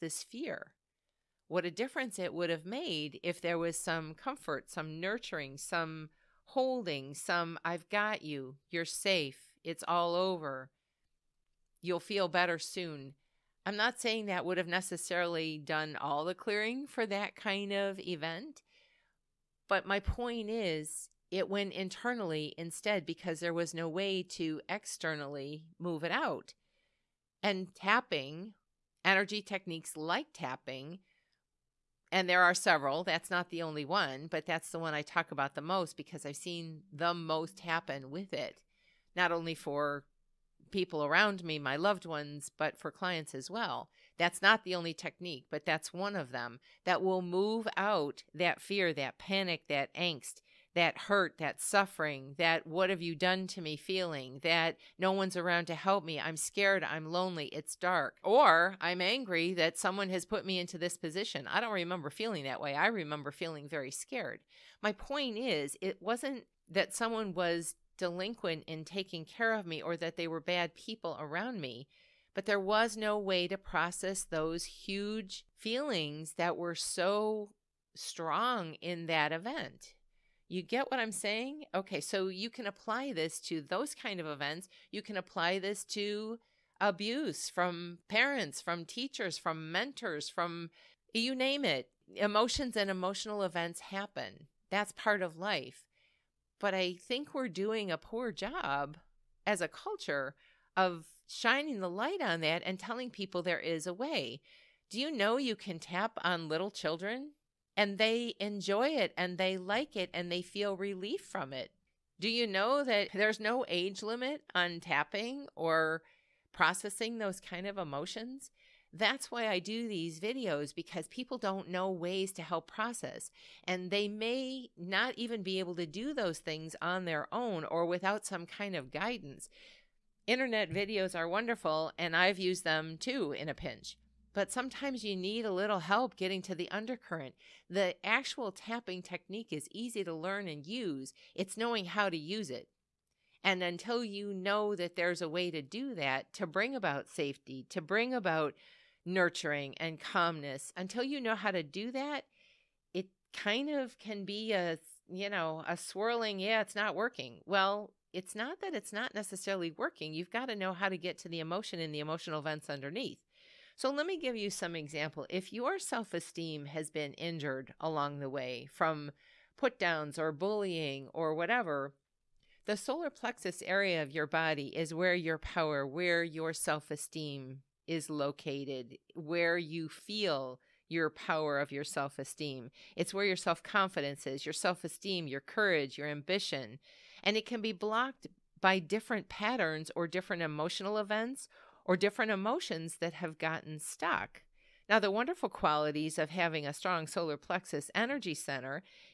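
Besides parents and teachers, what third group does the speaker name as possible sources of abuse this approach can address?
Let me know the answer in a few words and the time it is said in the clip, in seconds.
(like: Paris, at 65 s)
mentors, at 89 s.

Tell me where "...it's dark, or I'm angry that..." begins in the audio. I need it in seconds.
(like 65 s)
57 s.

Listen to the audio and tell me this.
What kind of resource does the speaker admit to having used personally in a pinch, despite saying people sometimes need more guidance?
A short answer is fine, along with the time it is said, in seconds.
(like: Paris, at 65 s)
Internet videos, at 130 s.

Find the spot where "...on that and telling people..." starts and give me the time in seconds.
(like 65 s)
102 s.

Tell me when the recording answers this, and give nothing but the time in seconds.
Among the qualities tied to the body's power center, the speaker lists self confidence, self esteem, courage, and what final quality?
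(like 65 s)
186 s.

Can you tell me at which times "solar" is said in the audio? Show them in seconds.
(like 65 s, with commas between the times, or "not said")
172 s, 197 s.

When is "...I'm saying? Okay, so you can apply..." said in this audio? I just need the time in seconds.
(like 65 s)
80 s.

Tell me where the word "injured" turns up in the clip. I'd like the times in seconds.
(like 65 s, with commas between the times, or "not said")
167 s.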